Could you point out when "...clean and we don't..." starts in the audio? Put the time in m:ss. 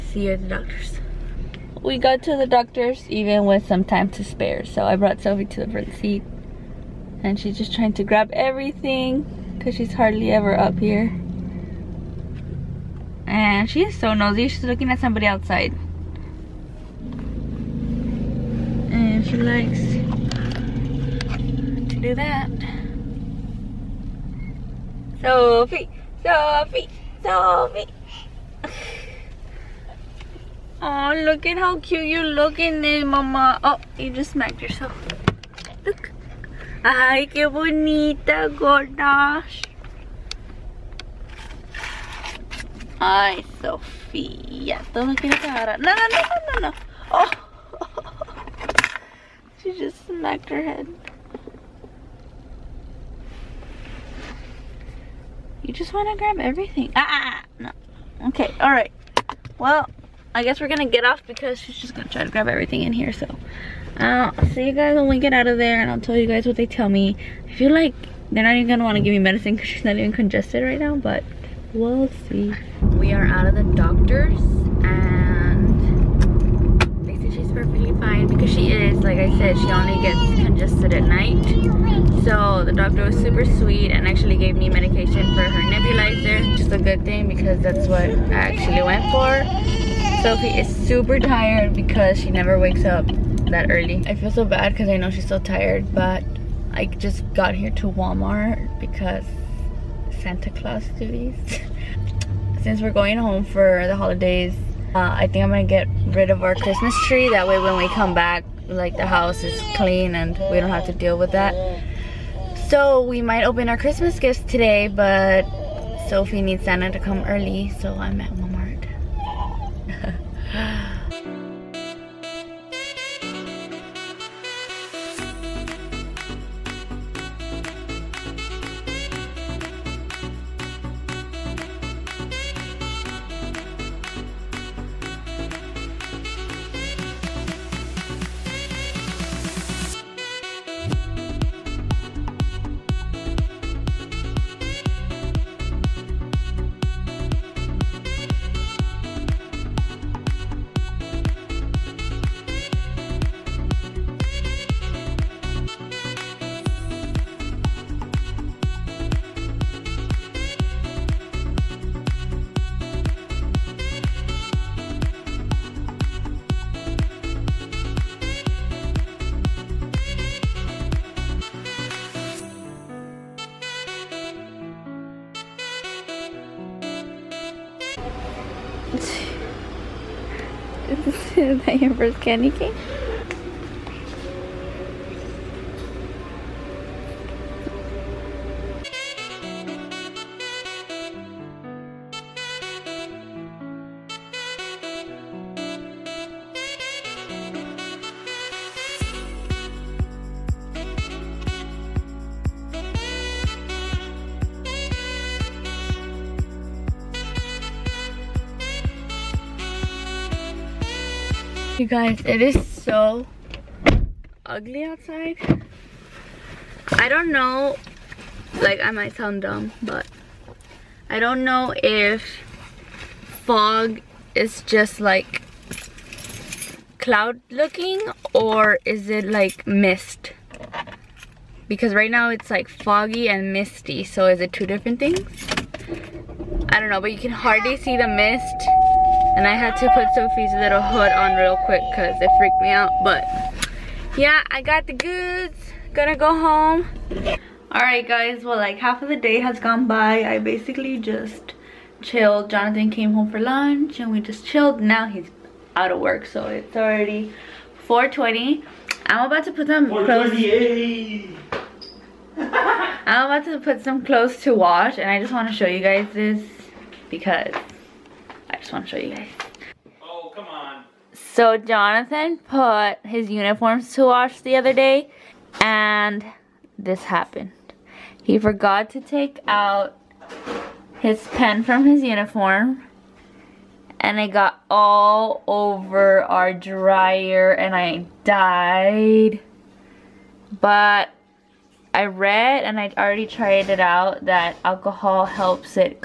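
1:49.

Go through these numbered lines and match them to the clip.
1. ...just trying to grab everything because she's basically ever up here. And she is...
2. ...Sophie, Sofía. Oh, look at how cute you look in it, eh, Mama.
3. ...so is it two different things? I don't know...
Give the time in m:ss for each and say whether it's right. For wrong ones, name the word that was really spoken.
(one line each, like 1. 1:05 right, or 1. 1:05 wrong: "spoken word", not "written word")
1. 0:07 wrong: "hardly", not "basically"
2. 0:26 wrong: "Sophie", not "Sofía"
3. 3:54 right.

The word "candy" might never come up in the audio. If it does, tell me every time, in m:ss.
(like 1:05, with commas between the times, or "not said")
3:02.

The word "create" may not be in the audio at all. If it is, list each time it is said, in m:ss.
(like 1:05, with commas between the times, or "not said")
not said.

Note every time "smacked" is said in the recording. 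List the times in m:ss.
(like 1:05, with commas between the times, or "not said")
0:34, 0:50.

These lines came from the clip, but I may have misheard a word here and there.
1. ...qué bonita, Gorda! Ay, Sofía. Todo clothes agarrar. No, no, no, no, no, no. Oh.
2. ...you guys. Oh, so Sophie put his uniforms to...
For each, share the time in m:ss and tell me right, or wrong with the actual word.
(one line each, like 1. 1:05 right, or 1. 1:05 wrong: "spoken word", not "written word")
1. 0:37 wrong: "quieres", not "clothes"
2. 4:29 wrong: "Jonathan", not "Sophie".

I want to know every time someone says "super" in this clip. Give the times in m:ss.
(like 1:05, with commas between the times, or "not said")
1:23, 1:30.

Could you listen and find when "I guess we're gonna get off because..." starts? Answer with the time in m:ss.
1:00.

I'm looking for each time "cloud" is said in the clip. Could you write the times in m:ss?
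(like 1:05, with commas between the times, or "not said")
3:46.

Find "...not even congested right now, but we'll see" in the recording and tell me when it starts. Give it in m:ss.
1:09.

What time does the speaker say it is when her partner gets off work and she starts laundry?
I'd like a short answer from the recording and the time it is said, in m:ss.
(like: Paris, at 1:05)
4:20, at 4:17.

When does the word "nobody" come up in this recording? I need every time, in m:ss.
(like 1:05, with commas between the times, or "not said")
not said.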